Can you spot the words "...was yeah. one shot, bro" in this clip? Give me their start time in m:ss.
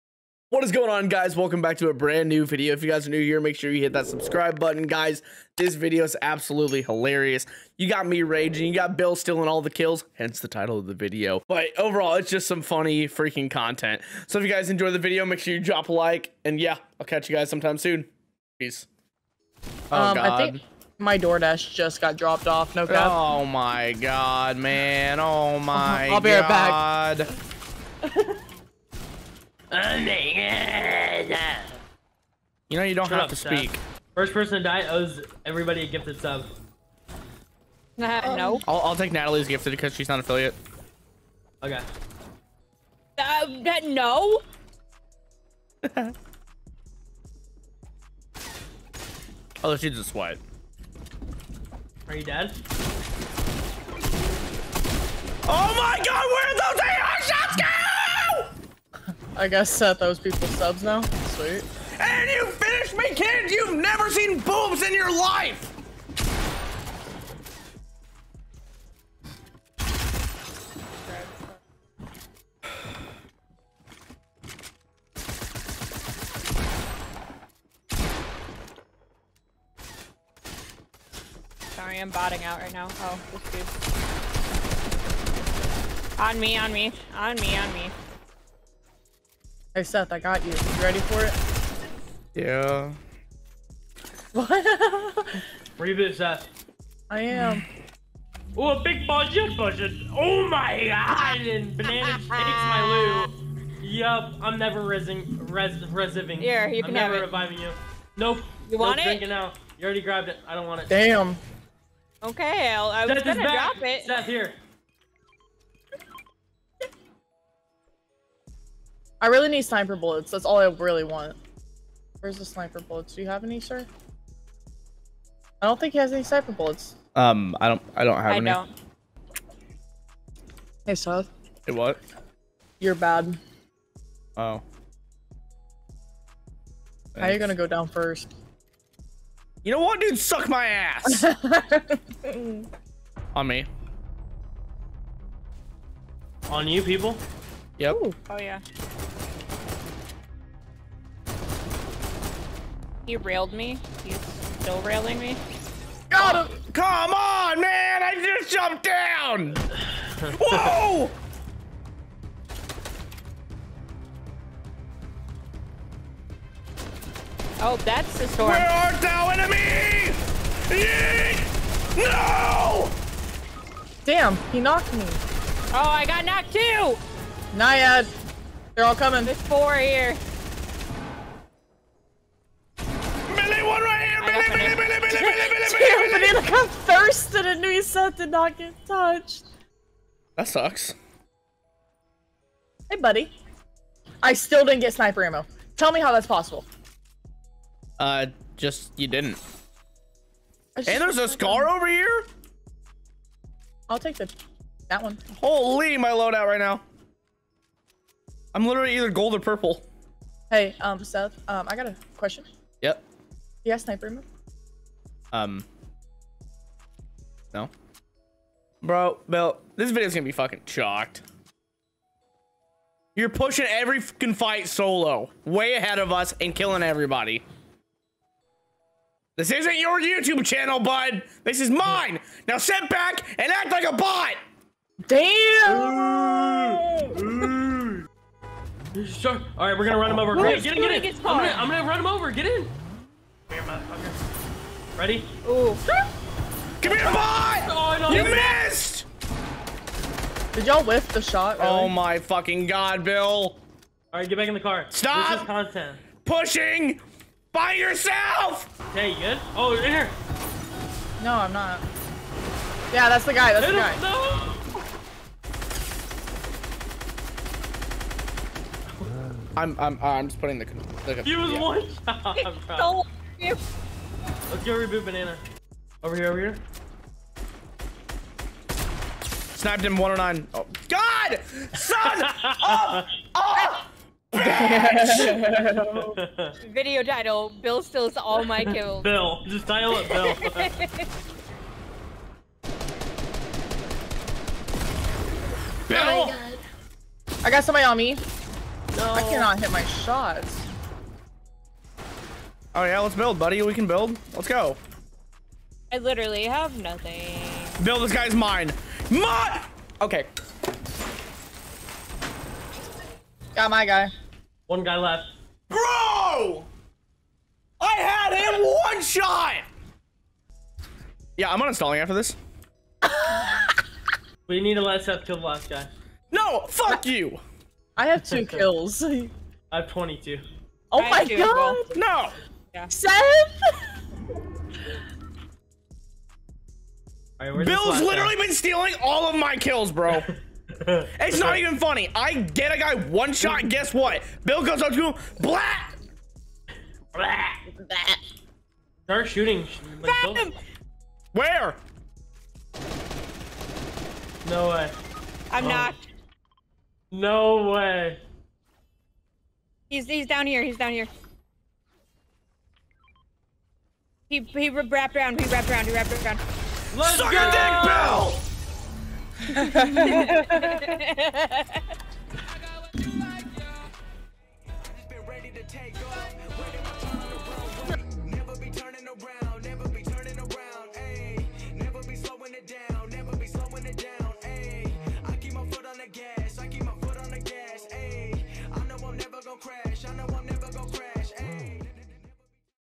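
4:31.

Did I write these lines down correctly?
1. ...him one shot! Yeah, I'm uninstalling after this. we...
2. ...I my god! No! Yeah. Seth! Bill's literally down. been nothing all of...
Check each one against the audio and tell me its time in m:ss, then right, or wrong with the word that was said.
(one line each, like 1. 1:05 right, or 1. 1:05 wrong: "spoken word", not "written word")
1. 5:18 right
2. 5:31 wrong: "stealing", not "nothing".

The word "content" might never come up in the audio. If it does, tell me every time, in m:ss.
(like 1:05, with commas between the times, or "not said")
0:13, 4:15.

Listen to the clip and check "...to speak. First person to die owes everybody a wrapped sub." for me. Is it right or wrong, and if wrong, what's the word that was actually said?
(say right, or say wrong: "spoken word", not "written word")
wrong: "gifted", not "wrapped".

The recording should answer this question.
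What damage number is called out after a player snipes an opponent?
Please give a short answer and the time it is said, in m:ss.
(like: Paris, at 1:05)
109, at 4:39.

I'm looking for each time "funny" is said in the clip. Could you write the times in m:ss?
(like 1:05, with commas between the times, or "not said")
0:12, 5:41.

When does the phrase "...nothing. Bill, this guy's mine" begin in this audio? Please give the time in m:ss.
5:06.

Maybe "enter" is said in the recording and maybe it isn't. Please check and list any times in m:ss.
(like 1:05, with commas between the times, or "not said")
not said.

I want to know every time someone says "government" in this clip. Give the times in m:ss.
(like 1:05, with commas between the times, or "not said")
not said.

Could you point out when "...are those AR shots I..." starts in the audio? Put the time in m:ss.
0:56.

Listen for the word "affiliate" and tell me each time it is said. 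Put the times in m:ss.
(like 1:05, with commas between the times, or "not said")
0:40.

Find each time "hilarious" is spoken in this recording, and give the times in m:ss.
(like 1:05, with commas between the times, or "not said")
0:06.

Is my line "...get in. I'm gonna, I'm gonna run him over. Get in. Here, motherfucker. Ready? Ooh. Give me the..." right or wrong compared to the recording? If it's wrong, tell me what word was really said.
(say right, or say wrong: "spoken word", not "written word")
right.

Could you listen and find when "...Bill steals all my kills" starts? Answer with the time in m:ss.
4:47.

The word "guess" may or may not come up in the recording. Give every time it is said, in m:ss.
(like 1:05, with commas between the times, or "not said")
0:59, 5:43.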